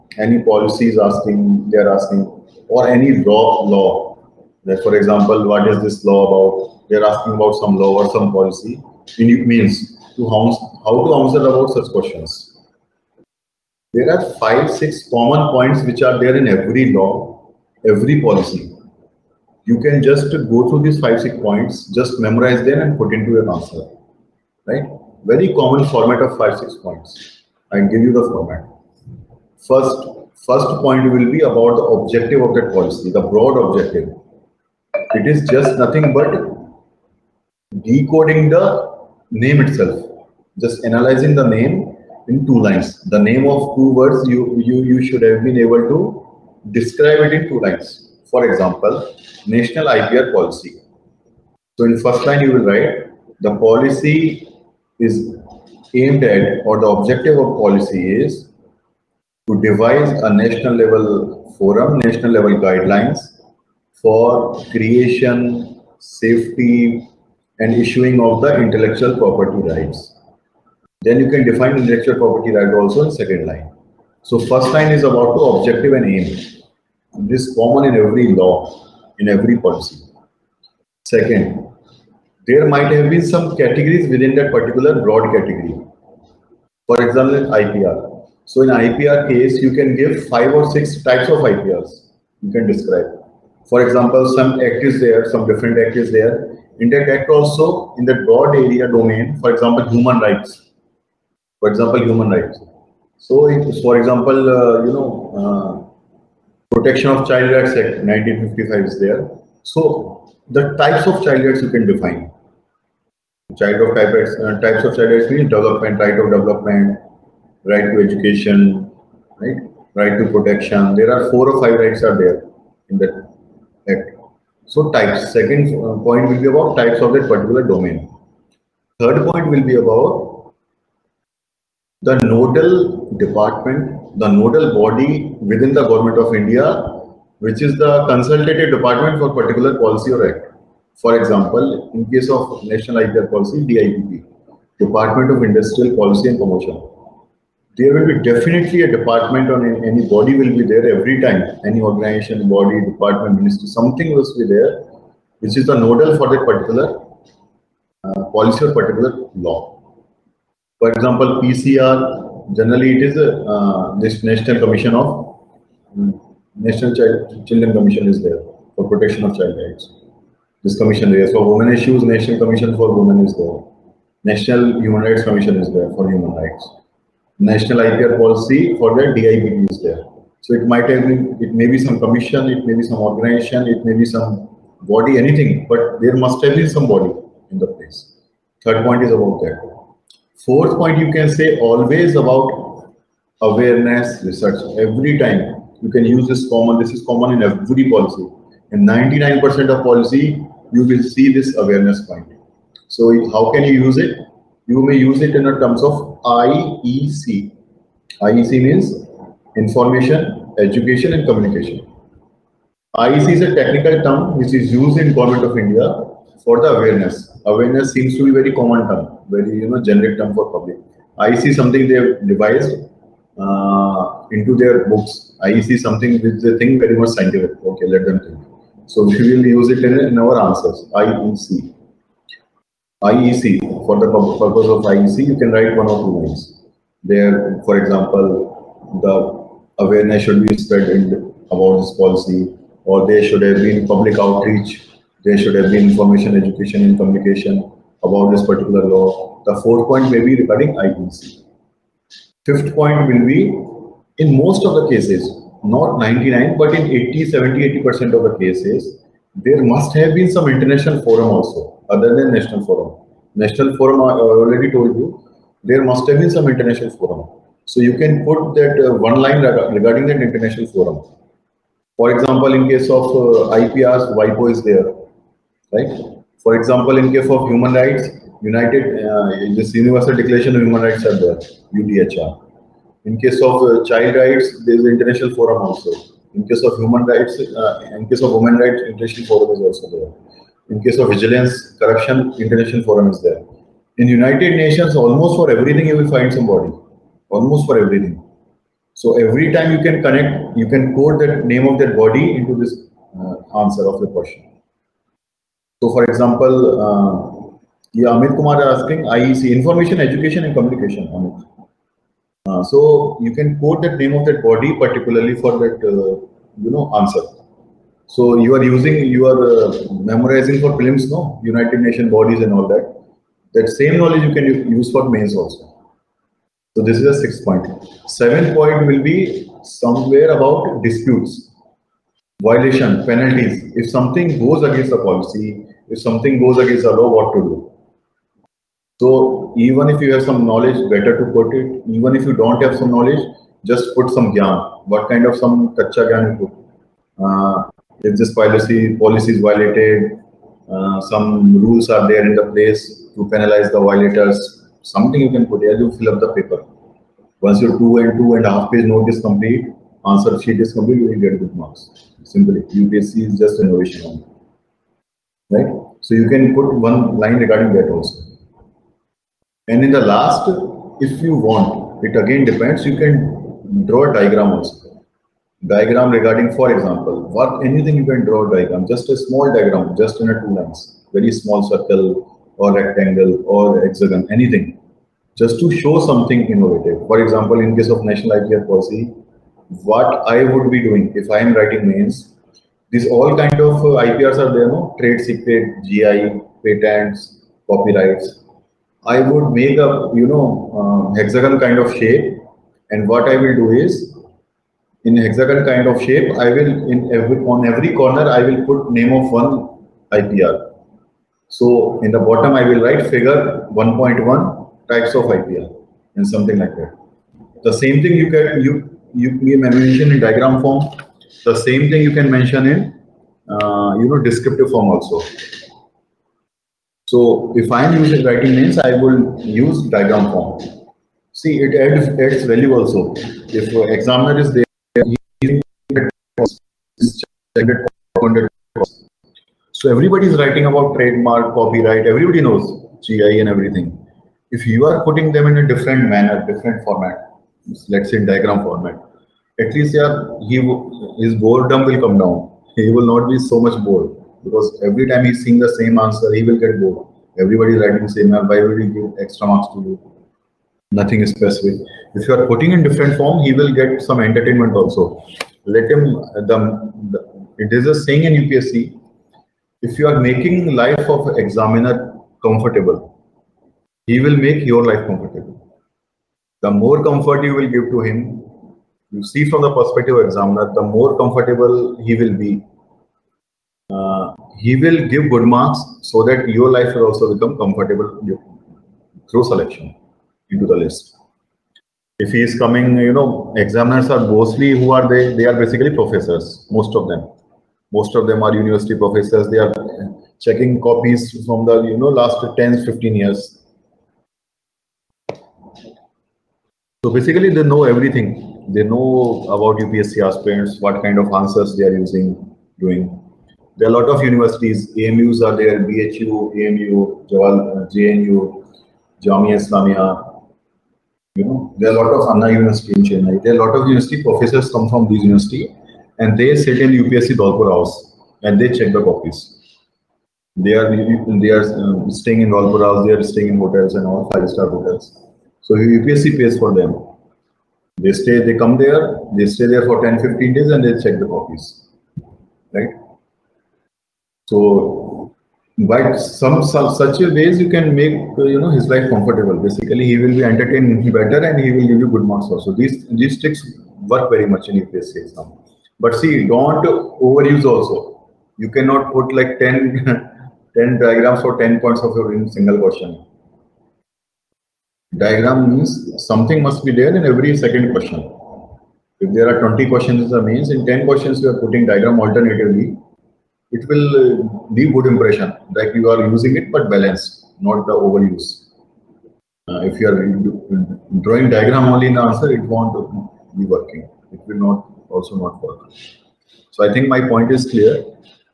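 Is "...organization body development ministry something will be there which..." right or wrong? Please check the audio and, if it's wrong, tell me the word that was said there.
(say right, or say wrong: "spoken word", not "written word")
wrong: "department", not "development".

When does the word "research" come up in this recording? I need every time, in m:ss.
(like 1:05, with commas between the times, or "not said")
3:14.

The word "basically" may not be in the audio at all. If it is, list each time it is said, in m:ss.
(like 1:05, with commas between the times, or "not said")
8:15, 8:27, 9:09.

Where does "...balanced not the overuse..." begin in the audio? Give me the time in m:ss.
9:36.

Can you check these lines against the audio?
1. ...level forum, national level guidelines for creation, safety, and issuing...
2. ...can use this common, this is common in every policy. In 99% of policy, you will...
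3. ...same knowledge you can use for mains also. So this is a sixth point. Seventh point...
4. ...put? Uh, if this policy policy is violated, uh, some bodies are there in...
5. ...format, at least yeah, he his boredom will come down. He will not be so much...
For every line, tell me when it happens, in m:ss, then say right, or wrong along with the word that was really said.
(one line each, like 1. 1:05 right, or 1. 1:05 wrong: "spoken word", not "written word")
1. 1:00 right
2. 3:15 right
3. 5:23 right
4. 5:46 wrong: "rules", not "bodies"
5. 7:28 right.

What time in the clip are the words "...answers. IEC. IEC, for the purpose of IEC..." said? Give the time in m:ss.
3:50.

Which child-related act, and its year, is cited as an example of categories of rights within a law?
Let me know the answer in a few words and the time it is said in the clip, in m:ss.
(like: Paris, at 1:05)
Protection of Child Rights Act 1955, at 1:46.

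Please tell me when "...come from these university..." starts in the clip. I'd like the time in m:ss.
8:44.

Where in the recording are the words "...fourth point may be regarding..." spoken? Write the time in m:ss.
4:09.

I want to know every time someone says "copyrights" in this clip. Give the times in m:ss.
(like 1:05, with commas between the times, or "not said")
6:37, 7:21.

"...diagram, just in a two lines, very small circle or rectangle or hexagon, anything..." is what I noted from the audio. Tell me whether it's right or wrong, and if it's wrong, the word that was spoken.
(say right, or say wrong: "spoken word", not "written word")
right.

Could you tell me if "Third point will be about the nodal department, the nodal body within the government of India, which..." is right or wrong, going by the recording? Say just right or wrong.
right.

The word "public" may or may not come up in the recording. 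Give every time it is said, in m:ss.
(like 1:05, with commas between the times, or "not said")
3:40, 4:03.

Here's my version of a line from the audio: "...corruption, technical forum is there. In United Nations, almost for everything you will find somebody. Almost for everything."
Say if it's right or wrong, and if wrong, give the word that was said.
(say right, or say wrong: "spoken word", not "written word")
wrong: "international", not "technical".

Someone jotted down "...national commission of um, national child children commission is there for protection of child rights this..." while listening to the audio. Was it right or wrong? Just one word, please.
right.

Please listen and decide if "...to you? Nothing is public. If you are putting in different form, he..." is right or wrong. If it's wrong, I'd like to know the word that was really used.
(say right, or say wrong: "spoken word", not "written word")
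wrong: "specific", not "public".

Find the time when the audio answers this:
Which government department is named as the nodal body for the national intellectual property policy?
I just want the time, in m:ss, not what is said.
2:24.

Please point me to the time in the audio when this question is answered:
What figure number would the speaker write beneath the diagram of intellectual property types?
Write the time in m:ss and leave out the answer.
6:53.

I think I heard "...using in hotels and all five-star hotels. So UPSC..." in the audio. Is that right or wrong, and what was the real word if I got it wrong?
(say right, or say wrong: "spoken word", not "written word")
wrong: "staying", not "using".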